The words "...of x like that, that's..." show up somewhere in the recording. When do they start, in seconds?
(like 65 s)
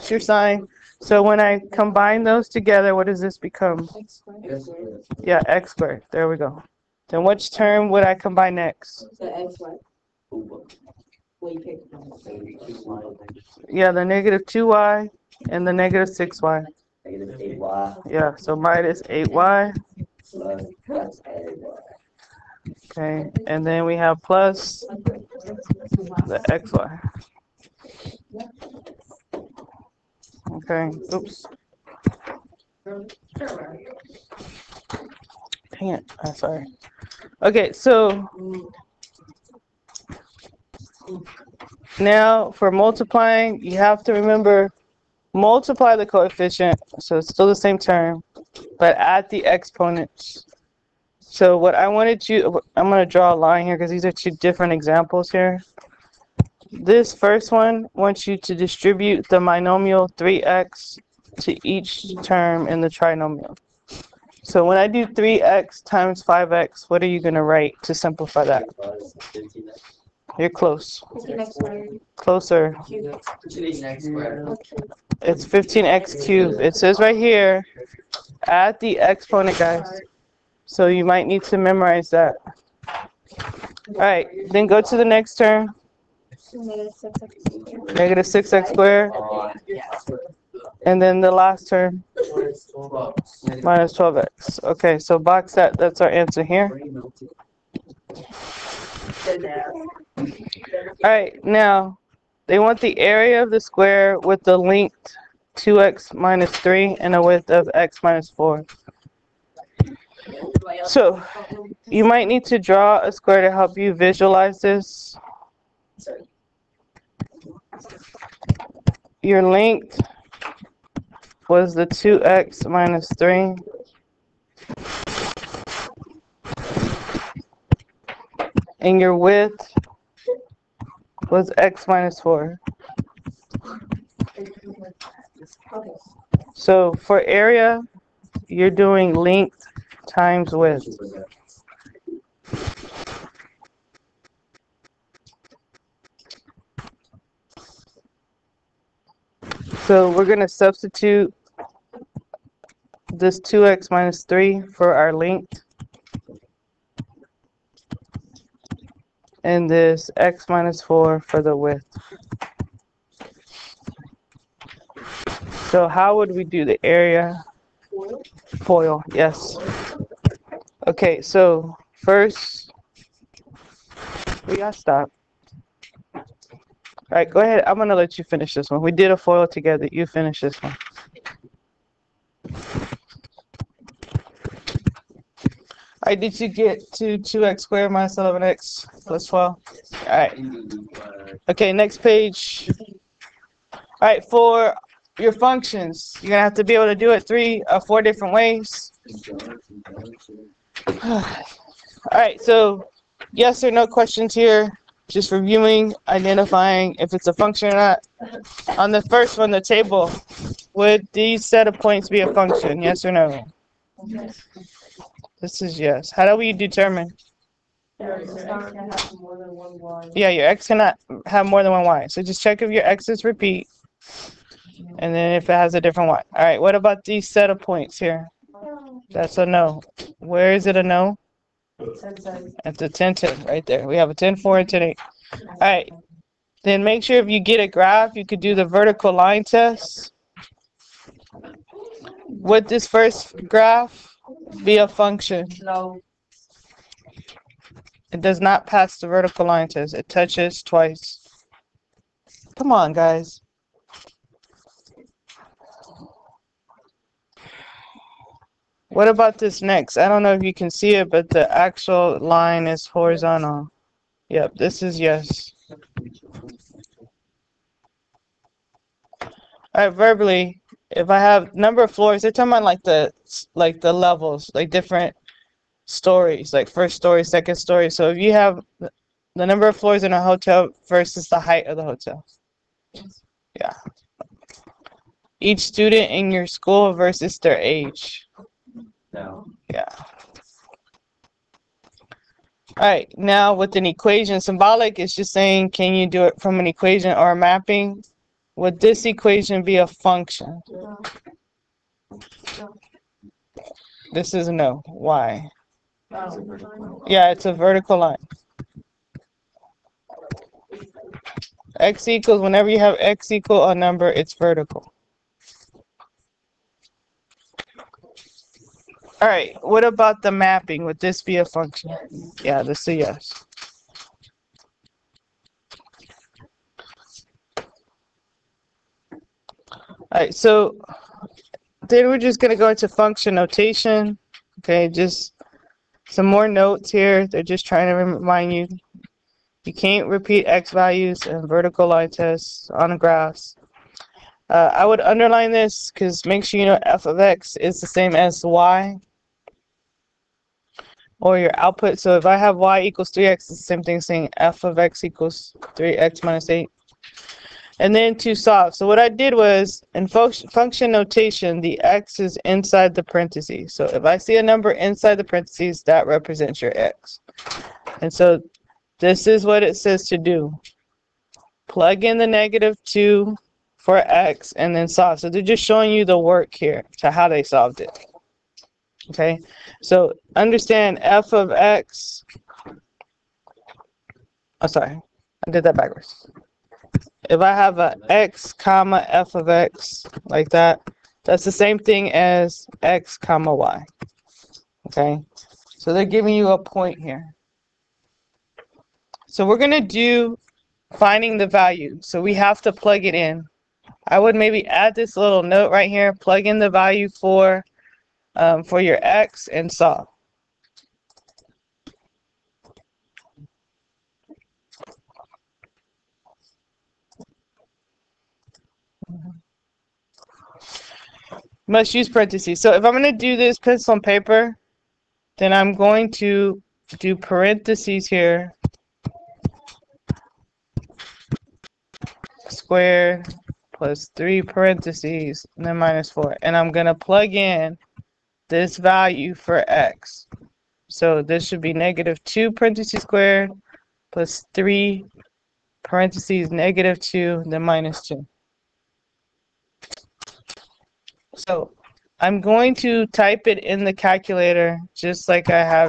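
389 s.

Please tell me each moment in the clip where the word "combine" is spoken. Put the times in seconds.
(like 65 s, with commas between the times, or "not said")
1 s, 8 s.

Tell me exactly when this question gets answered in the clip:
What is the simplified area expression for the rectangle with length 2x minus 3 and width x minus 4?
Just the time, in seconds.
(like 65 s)
187 s.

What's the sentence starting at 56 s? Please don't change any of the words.
This first one wants you to distribute the binomial 3x to each term in the trinomial.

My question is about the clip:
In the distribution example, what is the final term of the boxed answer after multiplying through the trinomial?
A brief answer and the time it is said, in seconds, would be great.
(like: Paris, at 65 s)
-12x, at 92 s.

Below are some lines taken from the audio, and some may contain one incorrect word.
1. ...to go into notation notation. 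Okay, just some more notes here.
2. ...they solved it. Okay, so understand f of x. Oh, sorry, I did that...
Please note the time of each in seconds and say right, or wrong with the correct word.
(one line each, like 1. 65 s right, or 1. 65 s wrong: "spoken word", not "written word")
1. 332 s wrong: "function", not "notation"
2. 377 s right.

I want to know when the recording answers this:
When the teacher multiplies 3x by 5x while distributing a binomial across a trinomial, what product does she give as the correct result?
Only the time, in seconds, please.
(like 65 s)
75 s.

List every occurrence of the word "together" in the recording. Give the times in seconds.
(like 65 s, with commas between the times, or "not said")
2 s, 179 s.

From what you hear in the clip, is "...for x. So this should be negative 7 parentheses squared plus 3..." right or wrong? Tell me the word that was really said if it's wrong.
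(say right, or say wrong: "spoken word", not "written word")
wrong: "2", not "7".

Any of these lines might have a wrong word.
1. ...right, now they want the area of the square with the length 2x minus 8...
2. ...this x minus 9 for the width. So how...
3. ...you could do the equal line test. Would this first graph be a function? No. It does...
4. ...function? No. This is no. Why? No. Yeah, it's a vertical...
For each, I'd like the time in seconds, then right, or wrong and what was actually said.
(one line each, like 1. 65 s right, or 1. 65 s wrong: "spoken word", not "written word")
1. 101 s wrong: "3", not "8"
2. 159 s wrong: "4", not "9"
3. 238 s wrong: "vertical", not "equal"
4. 299 s right.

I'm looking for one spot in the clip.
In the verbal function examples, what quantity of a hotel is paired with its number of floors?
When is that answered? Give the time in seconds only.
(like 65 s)
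281 s.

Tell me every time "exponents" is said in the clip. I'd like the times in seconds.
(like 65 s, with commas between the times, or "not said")
49 s, 78 s.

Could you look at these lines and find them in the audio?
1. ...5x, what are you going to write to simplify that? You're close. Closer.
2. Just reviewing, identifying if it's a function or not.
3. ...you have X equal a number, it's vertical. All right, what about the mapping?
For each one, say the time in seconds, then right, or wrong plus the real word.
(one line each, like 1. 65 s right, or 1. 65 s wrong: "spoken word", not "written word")
1. 66 s right
2. 205 s right
3. 312 s right.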